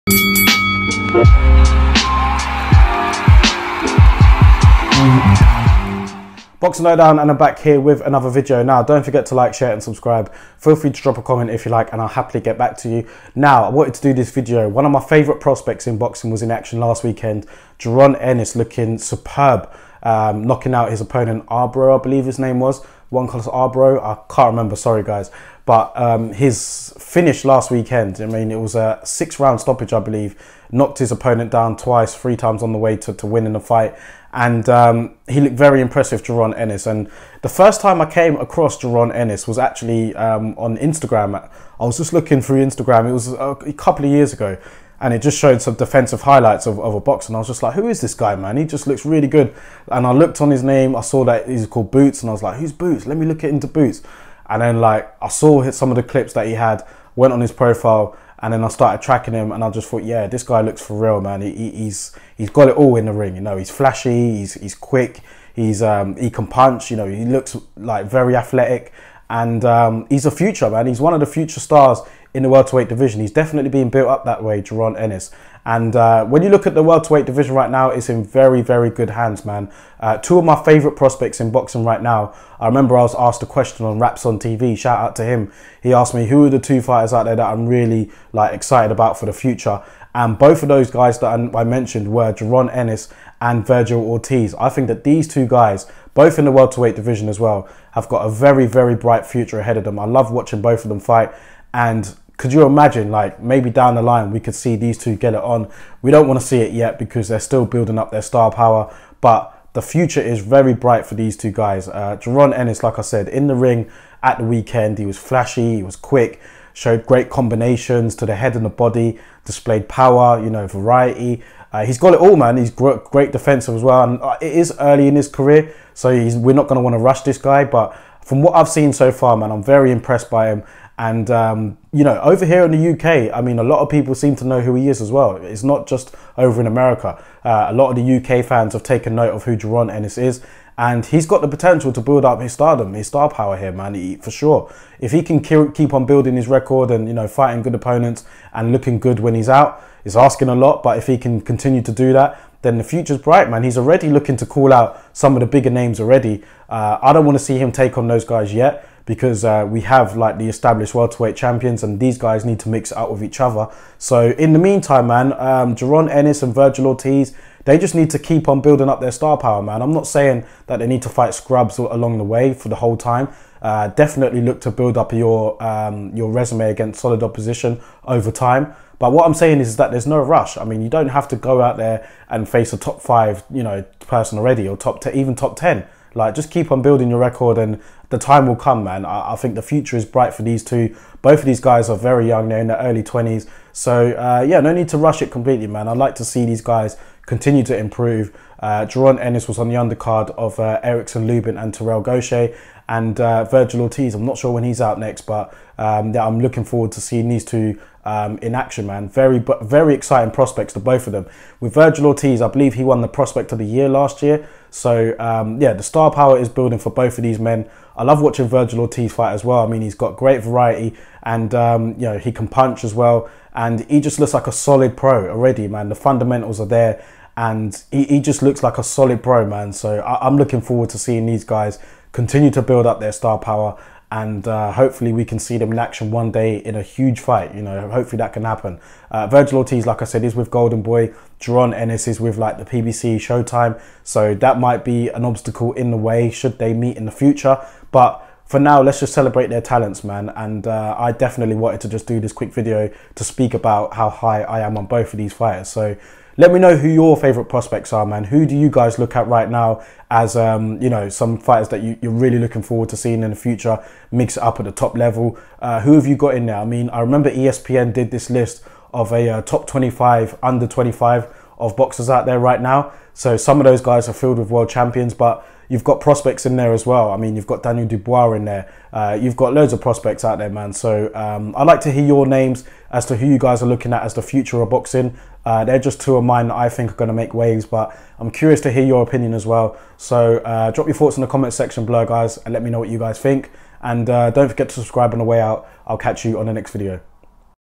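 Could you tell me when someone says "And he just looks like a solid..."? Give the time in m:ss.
3:43.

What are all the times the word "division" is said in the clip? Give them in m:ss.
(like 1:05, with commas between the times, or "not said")
1:12, 1:17, 1:36.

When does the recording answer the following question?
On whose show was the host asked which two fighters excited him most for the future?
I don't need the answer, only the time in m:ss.
1:23.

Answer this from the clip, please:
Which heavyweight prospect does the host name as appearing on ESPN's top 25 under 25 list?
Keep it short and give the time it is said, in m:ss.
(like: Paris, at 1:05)
Daniel Dubois, at 4:37.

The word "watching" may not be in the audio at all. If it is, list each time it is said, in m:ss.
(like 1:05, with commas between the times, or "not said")
1:40, 3:38.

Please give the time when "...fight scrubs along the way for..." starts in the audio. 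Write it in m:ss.
2:51.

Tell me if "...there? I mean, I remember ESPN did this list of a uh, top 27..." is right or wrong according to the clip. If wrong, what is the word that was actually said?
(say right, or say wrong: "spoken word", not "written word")
wrong: "25", not "27".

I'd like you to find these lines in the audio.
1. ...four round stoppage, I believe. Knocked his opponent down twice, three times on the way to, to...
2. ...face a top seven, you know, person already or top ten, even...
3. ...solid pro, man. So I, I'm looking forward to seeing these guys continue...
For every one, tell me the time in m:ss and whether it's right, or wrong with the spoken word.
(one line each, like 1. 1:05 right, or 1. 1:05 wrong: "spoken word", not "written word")
1. 0:29 wrong: "six", not "four"
2. 3:02 wrong: "five", not "seven"
3. 3:48 right.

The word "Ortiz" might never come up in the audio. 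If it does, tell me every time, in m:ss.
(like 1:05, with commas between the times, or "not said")
1:33, 2:46, 3:23, 3:32, 3:38, 3:59.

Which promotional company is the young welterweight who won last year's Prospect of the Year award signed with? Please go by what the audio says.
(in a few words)
Golden Boy.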